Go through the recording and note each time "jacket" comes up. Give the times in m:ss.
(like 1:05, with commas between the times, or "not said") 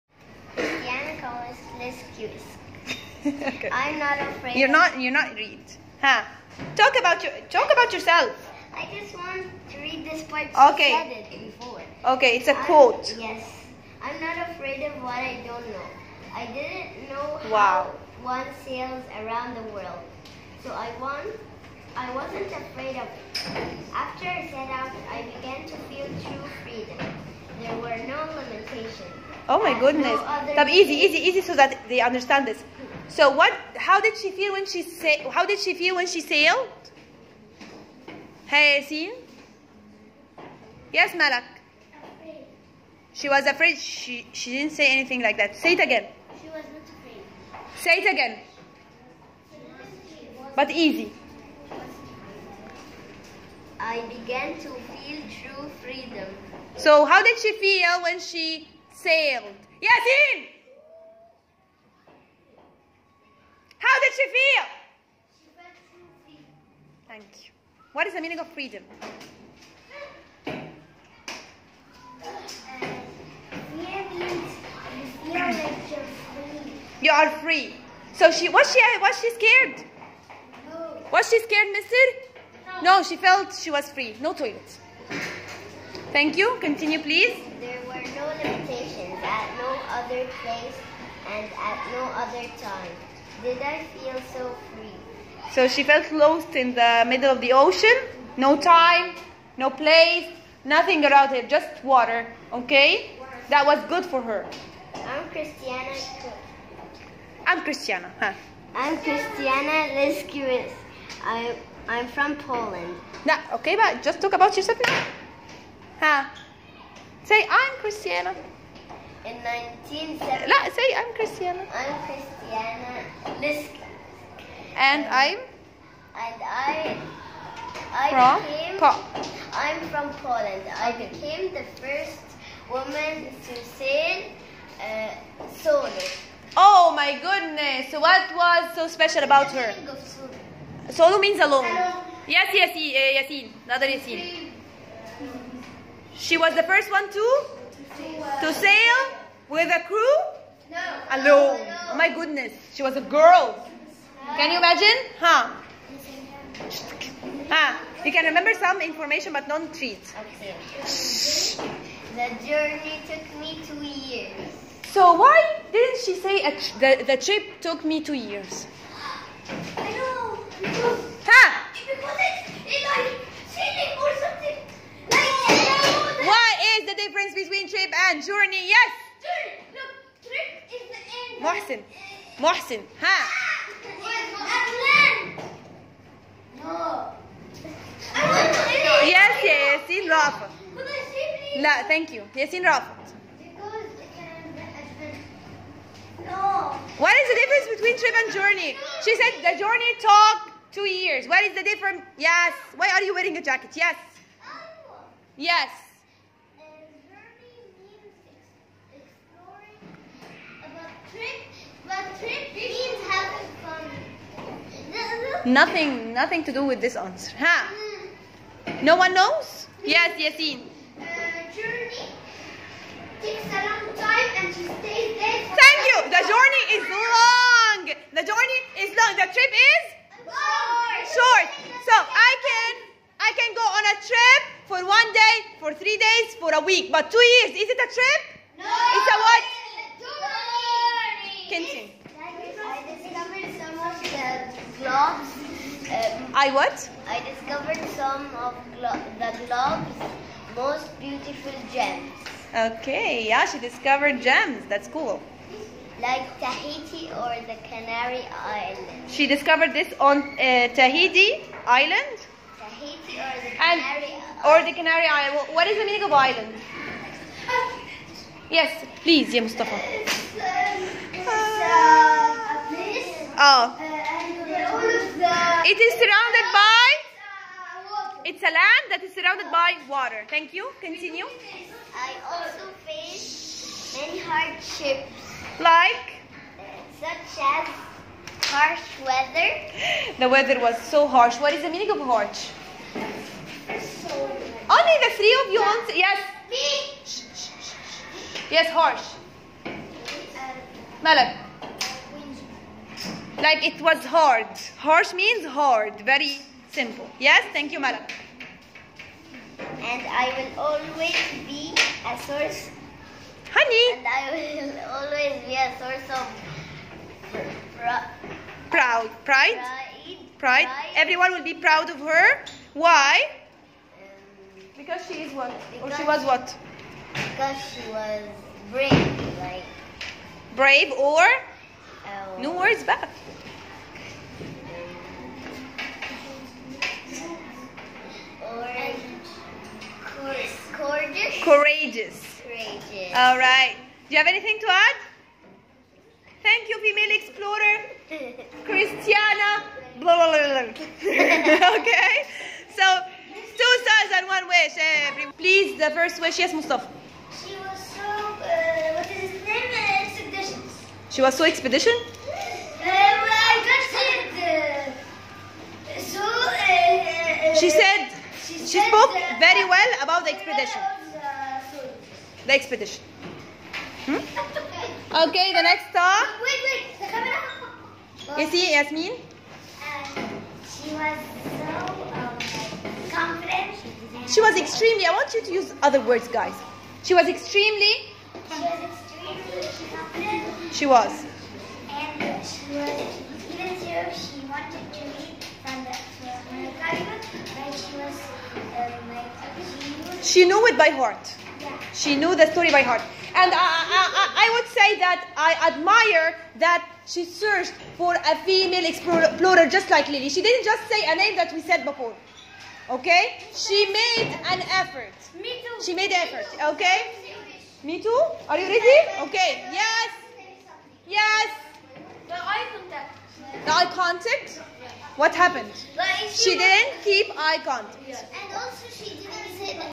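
3:23.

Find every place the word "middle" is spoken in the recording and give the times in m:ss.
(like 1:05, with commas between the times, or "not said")
1:37.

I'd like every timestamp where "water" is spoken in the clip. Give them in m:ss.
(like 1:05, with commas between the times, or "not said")
1:41, 4:39.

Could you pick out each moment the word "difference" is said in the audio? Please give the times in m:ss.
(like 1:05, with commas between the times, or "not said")
2:57, 3:17, 3:21.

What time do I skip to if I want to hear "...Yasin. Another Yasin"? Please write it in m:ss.
2:23.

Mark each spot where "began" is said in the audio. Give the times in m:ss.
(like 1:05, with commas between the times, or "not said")
0:25, 0:54.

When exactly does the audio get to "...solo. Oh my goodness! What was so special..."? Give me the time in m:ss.
2:15.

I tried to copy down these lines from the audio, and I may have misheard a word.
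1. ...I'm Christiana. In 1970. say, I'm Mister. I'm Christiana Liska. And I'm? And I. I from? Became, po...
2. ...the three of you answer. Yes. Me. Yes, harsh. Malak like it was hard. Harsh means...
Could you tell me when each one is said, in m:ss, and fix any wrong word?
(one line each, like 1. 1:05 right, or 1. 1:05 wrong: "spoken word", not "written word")
1. 1:57 wrong: "Christiana", not "Mister"
2. 4:55 right.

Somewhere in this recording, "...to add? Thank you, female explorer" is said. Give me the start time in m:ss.
5:44.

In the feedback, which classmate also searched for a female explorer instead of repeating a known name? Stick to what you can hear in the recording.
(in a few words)
Lily.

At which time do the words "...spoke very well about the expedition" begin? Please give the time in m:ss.
6:08.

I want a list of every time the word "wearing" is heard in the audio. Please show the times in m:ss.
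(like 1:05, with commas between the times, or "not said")
3:23.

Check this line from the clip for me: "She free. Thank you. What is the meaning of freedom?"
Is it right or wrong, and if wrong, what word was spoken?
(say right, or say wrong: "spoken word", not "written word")
right.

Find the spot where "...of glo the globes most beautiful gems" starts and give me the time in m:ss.
4:08.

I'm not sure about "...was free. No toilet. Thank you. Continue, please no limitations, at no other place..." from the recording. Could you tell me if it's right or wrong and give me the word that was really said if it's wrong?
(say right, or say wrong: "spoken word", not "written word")
right.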